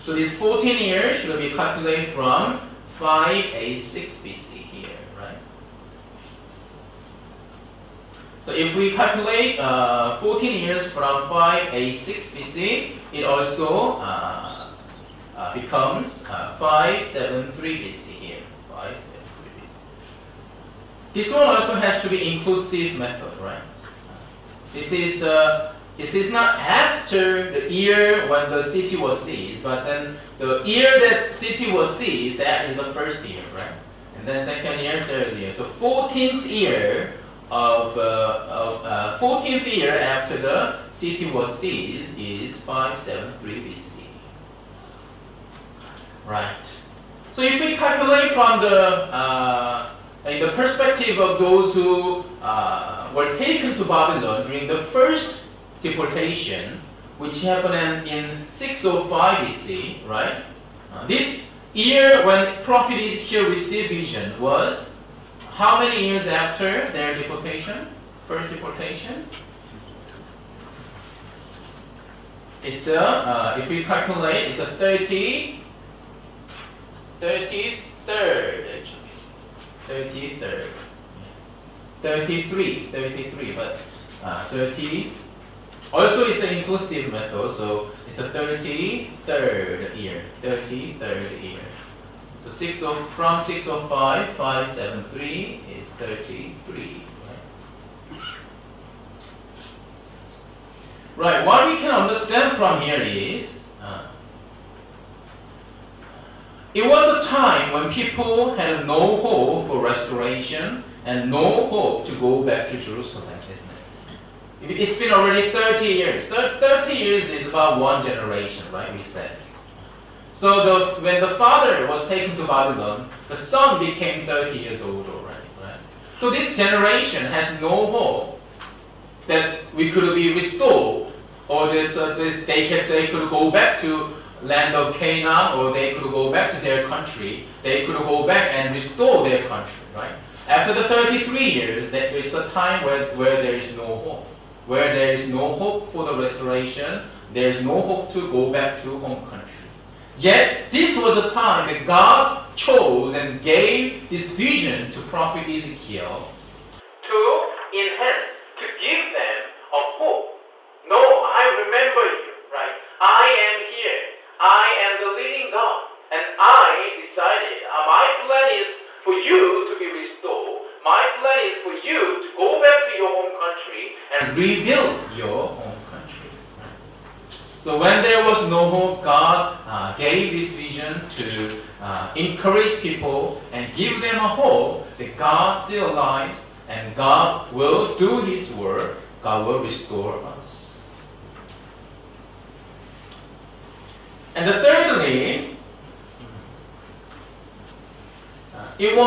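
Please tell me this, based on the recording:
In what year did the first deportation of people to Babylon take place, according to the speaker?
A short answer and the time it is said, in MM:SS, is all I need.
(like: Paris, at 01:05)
605 BC, at 00:58.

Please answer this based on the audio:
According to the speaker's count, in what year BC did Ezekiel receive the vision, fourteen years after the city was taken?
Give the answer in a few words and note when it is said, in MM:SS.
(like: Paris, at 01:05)
573 BC, at 00:16.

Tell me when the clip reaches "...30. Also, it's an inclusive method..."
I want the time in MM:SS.
01:24.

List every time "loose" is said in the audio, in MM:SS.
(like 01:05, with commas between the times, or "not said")
not said.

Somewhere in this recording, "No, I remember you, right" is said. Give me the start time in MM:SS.
02:40.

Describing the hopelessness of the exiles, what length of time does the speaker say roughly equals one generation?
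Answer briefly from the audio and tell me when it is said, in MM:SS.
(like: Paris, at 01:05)
30 years, at 01:56.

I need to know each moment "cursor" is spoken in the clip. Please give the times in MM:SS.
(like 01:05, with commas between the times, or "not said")
not said.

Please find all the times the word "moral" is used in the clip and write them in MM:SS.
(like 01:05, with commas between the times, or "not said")
not said.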